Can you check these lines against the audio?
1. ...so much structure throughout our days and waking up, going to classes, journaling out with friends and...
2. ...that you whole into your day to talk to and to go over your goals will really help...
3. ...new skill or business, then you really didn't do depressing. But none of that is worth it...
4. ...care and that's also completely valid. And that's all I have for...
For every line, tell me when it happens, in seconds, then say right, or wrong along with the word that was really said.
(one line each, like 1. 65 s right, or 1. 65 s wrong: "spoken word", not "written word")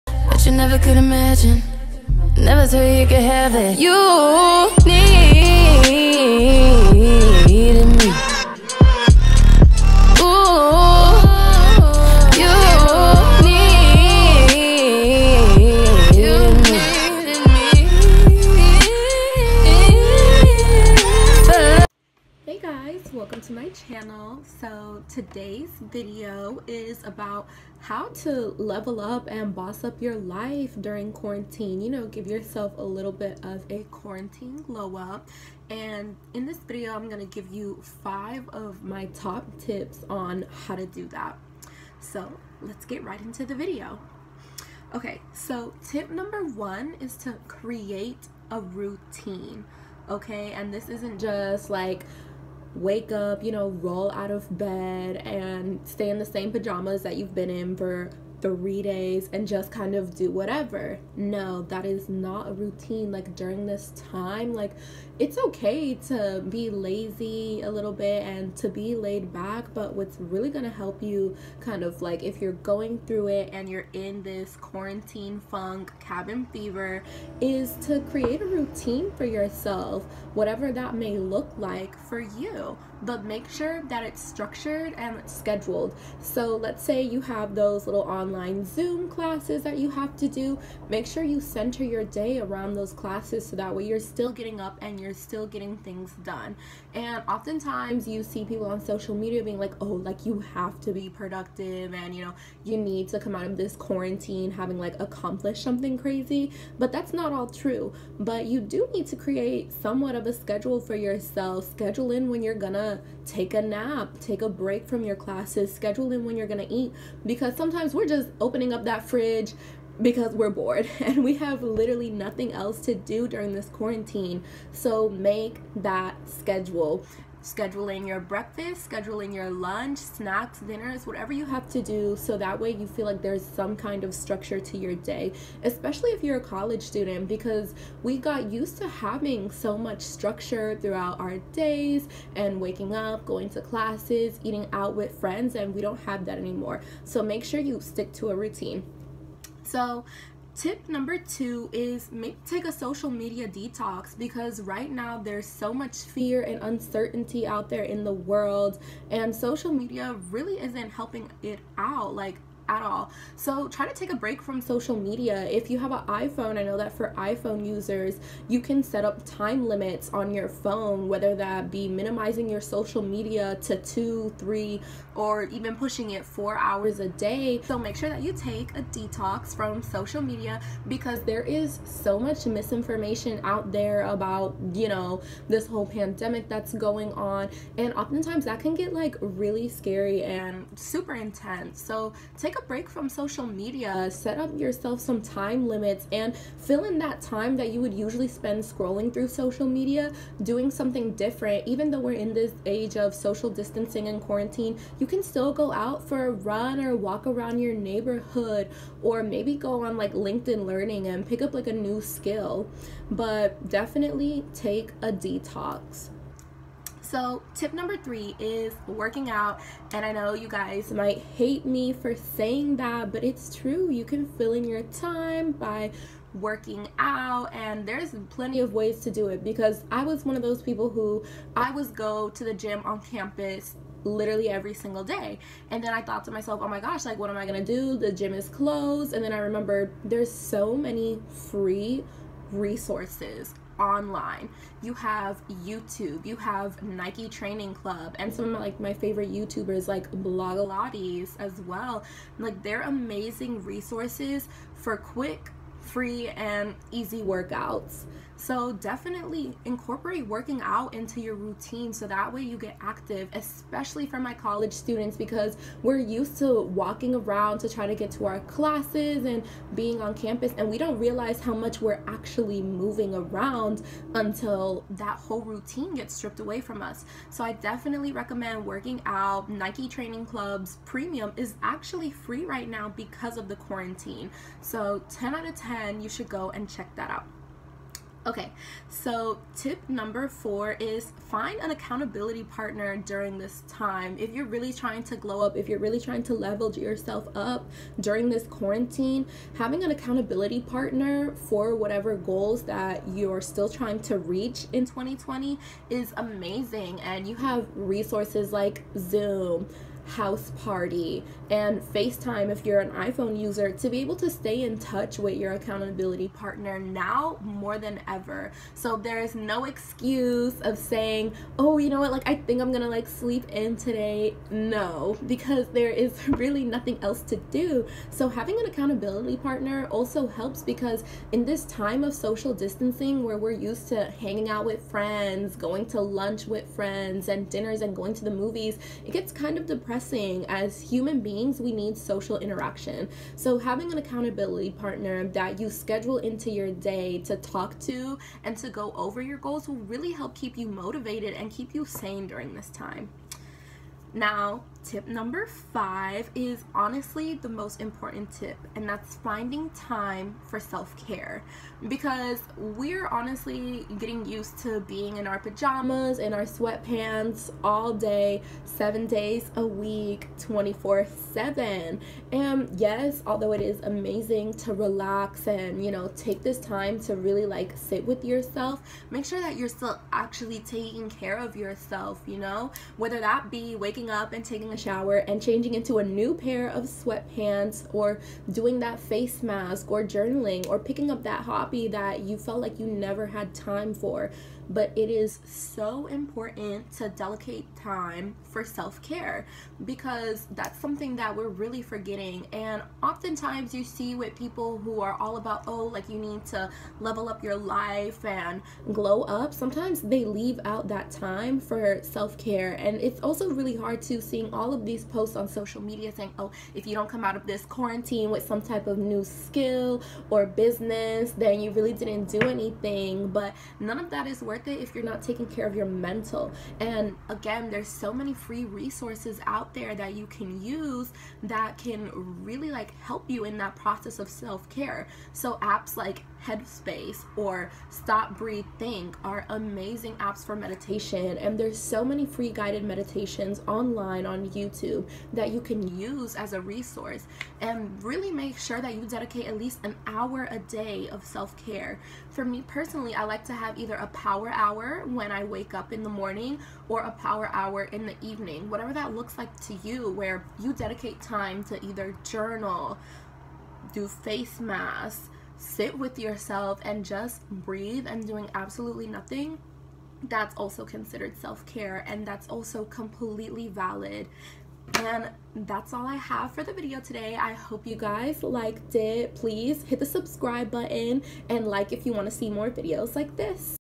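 1. 139 s wrong: "eating", not "journaling"
2. 345 s wrong: "schedule", not "whole"
3. 418 s wrong: "anything", not "depressing"
4. 471 s right.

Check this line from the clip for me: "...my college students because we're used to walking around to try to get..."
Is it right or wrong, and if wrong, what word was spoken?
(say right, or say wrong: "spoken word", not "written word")
right.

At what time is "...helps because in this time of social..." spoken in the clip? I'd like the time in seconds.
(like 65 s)
330 s.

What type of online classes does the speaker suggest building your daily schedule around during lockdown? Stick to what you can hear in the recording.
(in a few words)
Zoom classes.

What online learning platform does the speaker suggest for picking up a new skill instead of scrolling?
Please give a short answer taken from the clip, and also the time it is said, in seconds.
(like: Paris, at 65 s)
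LinkedIn Learning, at 210 s.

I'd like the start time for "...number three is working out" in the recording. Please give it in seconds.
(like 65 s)
217 s.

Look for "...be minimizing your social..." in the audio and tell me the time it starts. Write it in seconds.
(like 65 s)
171 s.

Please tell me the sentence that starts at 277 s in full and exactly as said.
So I definitely recommend working out.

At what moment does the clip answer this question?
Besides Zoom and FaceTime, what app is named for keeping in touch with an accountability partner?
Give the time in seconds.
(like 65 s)
310 s.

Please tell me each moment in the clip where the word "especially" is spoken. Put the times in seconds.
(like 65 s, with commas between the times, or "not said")
135 s, 263 s.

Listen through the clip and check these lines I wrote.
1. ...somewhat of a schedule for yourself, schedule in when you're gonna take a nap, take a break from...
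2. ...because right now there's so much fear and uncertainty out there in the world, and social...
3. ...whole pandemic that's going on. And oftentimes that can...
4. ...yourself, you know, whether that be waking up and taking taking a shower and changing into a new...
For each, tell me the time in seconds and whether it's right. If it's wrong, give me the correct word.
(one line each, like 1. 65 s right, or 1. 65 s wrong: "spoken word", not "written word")
1. 109 s right
2. 154 s right
3. 185 s right
4. 381 s right.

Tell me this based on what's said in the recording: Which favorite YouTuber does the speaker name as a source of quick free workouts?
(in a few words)
Blogilates.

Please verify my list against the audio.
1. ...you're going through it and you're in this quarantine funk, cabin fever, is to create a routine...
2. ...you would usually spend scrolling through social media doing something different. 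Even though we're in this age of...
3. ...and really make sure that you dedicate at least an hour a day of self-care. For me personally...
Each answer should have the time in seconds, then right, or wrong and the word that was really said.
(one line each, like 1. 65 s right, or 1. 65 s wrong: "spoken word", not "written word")
1. 72 s right
2. 197 s right
3. 447 s right.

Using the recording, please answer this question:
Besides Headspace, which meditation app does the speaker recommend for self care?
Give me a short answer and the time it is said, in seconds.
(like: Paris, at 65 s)
Stop Breathe Think, at 437 s.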